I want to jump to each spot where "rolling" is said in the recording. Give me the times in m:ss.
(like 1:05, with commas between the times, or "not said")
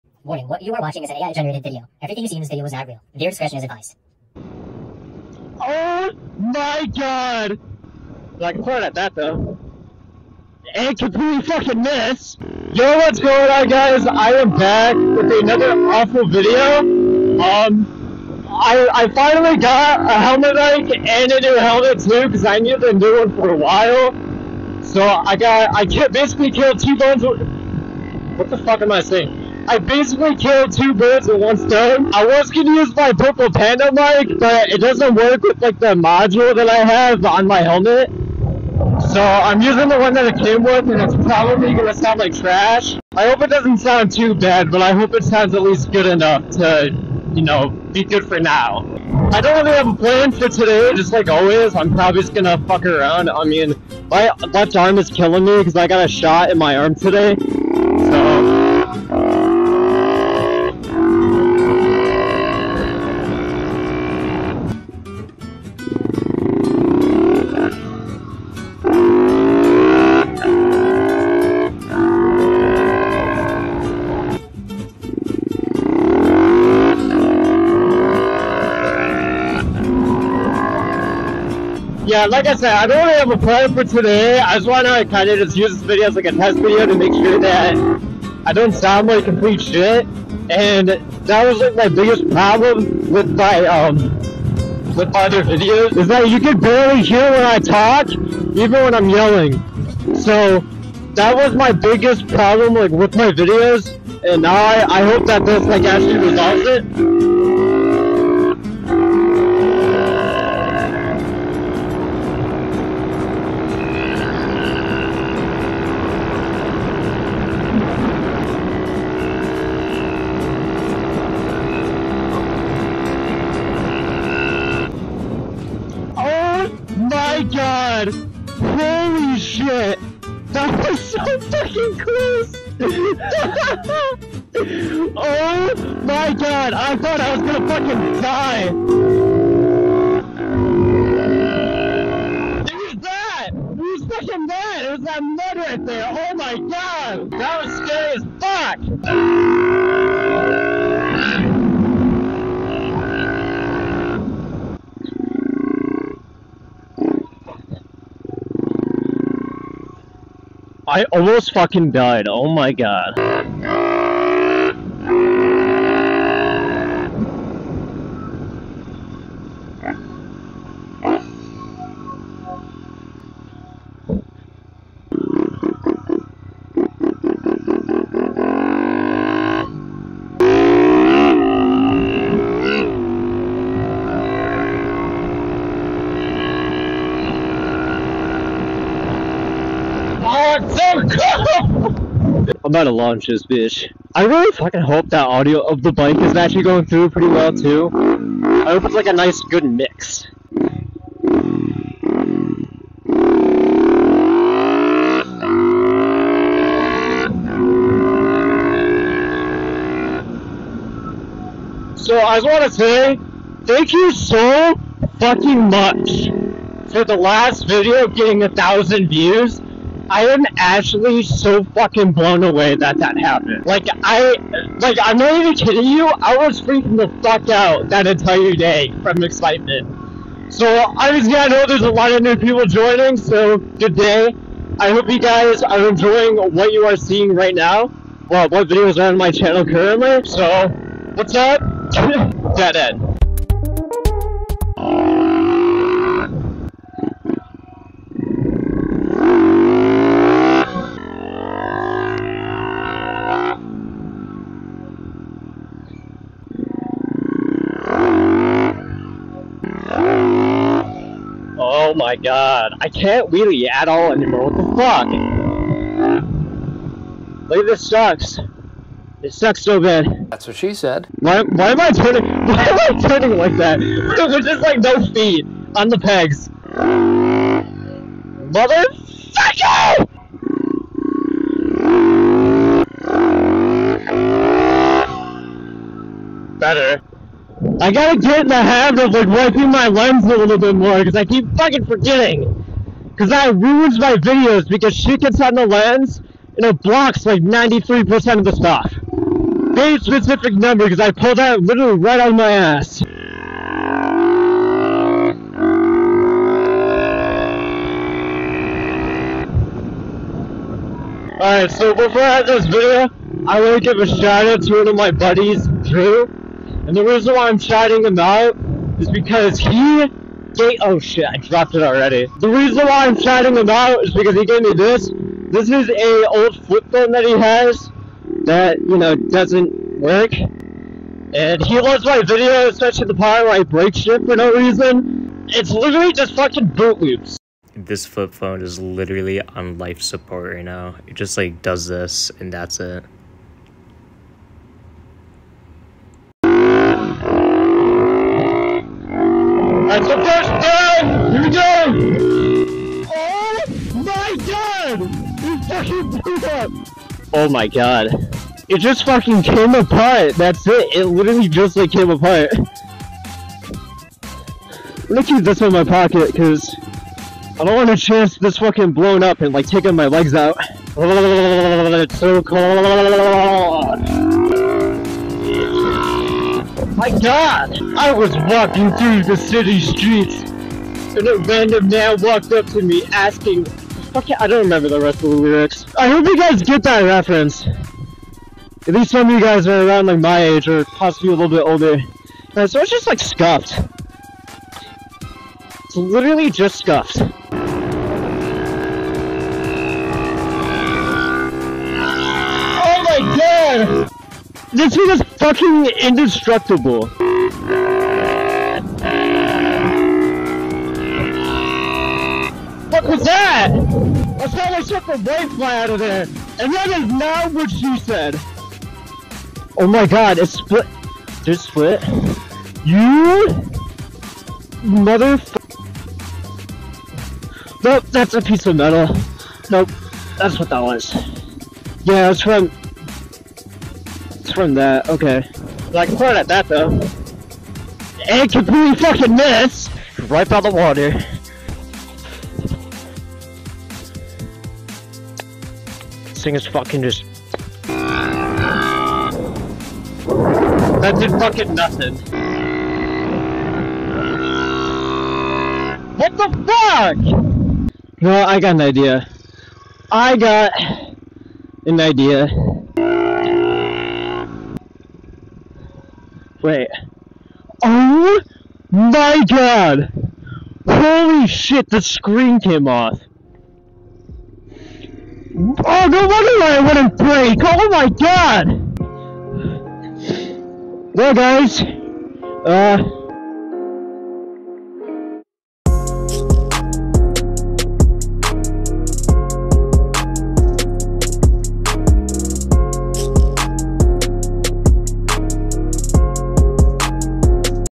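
not said.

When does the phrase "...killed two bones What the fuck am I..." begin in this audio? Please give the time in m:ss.
0:26.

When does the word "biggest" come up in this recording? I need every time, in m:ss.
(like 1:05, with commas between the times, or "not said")
1:31, 1:41.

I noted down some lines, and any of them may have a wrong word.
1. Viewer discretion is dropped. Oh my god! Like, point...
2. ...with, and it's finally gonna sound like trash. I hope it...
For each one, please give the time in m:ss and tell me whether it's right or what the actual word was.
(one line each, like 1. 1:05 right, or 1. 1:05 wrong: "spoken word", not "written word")
1. 0:03 wrong: "advised", not "dropped"
2. 0:40 wrong: "probably", not "finally".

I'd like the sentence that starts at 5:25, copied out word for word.
This is a old flip phone that he has that, you know, doesn't work.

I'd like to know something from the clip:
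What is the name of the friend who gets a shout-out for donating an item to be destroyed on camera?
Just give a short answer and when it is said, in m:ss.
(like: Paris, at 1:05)
Drew, at 5:15.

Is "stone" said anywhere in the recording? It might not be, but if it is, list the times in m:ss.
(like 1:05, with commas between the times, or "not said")
0:31.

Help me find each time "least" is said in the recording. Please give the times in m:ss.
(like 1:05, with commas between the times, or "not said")
0:45, 6:28.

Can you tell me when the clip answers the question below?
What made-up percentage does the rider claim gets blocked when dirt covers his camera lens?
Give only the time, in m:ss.
4:57.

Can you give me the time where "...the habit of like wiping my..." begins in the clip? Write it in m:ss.
4:48.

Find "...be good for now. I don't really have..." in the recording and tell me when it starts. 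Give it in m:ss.
0:47.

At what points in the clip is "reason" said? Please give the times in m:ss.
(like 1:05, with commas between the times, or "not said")
5:17, 5:22, 5:34.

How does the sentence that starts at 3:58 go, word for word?
Well, what videos are on my channel currently.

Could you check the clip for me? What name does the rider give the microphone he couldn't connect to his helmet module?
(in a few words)
purple panda.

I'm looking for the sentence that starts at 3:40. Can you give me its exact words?
I am actually so fucking blown away that that happened.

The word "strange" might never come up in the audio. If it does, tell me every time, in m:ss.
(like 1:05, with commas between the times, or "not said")
not said.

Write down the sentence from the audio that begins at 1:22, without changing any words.
Yeah, like I said, I don't really have a plan for today.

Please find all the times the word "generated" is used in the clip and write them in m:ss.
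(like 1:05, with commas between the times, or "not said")
0:01.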